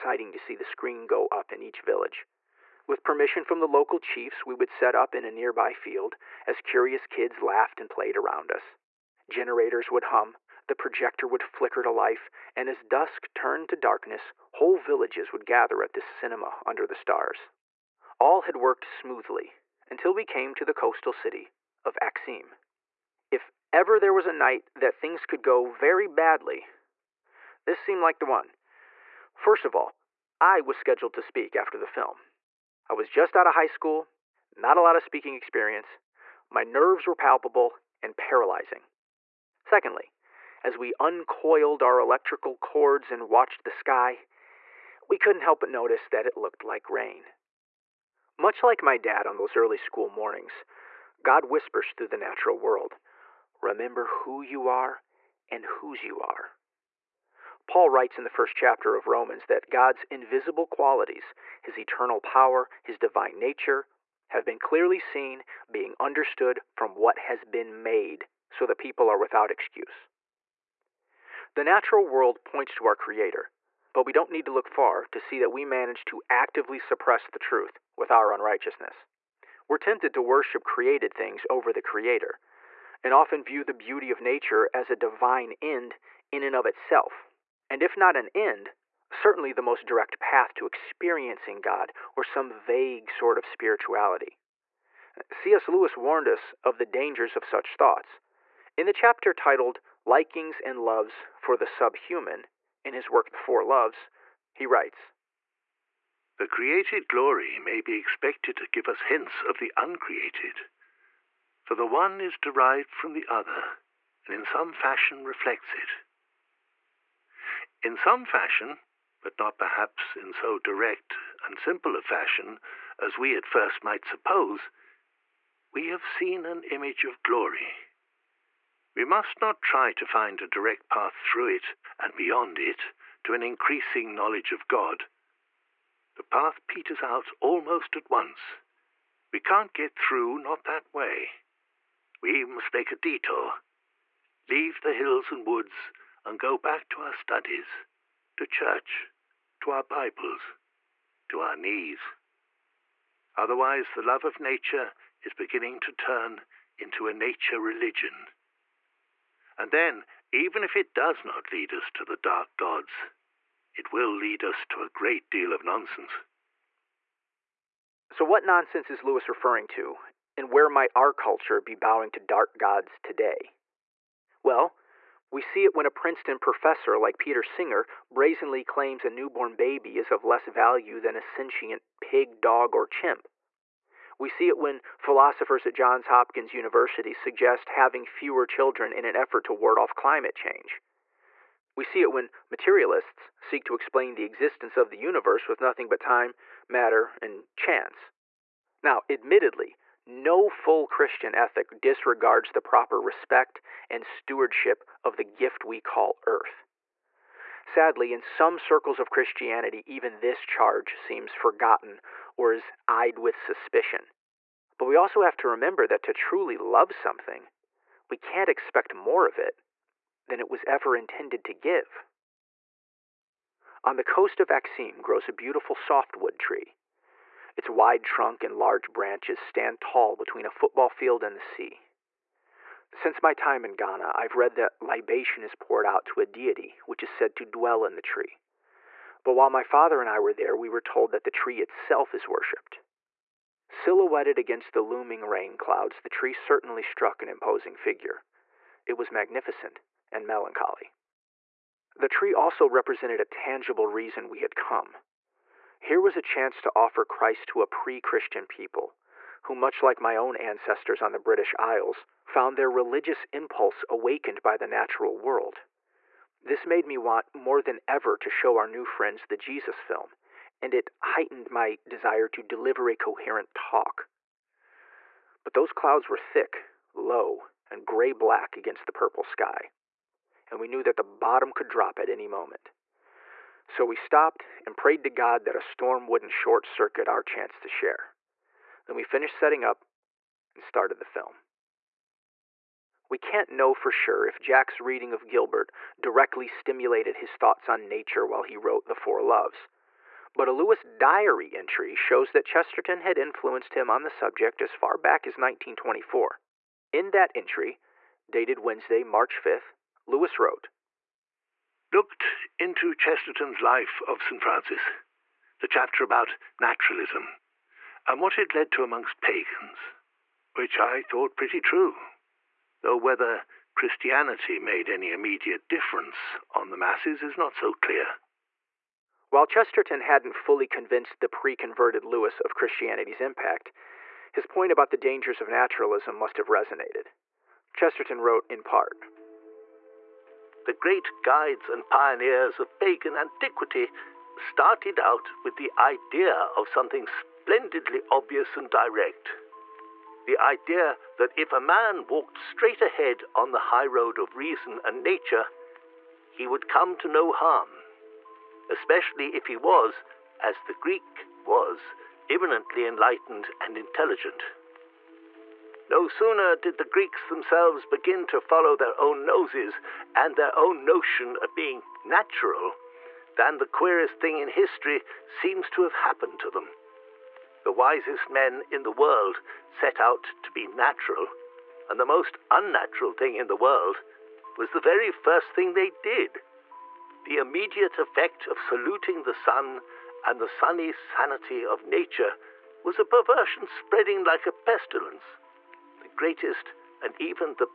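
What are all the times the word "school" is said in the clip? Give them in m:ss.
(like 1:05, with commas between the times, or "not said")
0:33, 0:49.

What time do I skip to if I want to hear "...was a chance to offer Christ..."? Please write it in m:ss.
4:16.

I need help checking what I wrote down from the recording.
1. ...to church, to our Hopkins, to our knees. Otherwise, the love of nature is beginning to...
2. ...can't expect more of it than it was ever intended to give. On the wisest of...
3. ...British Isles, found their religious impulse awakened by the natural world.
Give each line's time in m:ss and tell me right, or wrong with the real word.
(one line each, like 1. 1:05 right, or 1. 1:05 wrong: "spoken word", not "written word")
1. 2:28 wrong: "Bibles", not "Hopkins"
2. 3:38 wrong: "coast", not "wisest"
3. 4:21 right.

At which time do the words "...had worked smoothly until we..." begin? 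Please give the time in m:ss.
0:18.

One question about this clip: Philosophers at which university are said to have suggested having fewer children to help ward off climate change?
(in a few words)
Johns Hopkins University.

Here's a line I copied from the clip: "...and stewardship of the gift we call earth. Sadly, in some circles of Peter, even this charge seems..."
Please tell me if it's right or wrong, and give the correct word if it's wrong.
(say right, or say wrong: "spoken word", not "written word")
wrong: "Christianity", not "Peter".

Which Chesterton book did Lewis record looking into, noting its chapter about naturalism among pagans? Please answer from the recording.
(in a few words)
Life of St. Francis.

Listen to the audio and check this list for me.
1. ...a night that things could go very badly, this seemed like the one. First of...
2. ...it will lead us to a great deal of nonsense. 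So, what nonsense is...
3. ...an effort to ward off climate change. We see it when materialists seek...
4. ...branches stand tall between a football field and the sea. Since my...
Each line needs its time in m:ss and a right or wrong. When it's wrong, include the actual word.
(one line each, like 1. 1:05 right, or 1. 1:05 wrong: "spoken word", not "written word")
1. 0:24 right
2. 2:43 right
3. 3:09 right
4. 3:48 right.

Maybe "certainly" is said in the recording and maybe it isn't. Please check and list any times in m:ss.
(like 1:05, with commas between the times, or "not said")
1:29, 4:06.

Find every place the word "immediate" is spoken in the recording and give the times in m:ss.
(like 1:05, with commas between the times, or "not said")
5:25, 6:27.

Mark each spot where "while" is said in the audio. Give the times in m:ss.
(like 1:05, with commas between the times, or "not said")
3:59, 4:58, 5:29.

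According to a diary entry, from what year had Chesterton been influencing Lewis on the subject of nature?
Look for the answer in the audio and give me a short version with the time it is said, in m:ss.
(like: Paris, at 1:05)
1924, at 5:05.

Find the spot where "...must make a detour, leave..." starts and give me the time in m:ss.
2:22.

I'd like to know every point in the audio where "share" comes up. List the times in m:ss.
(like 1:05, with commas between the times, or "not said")
4:47.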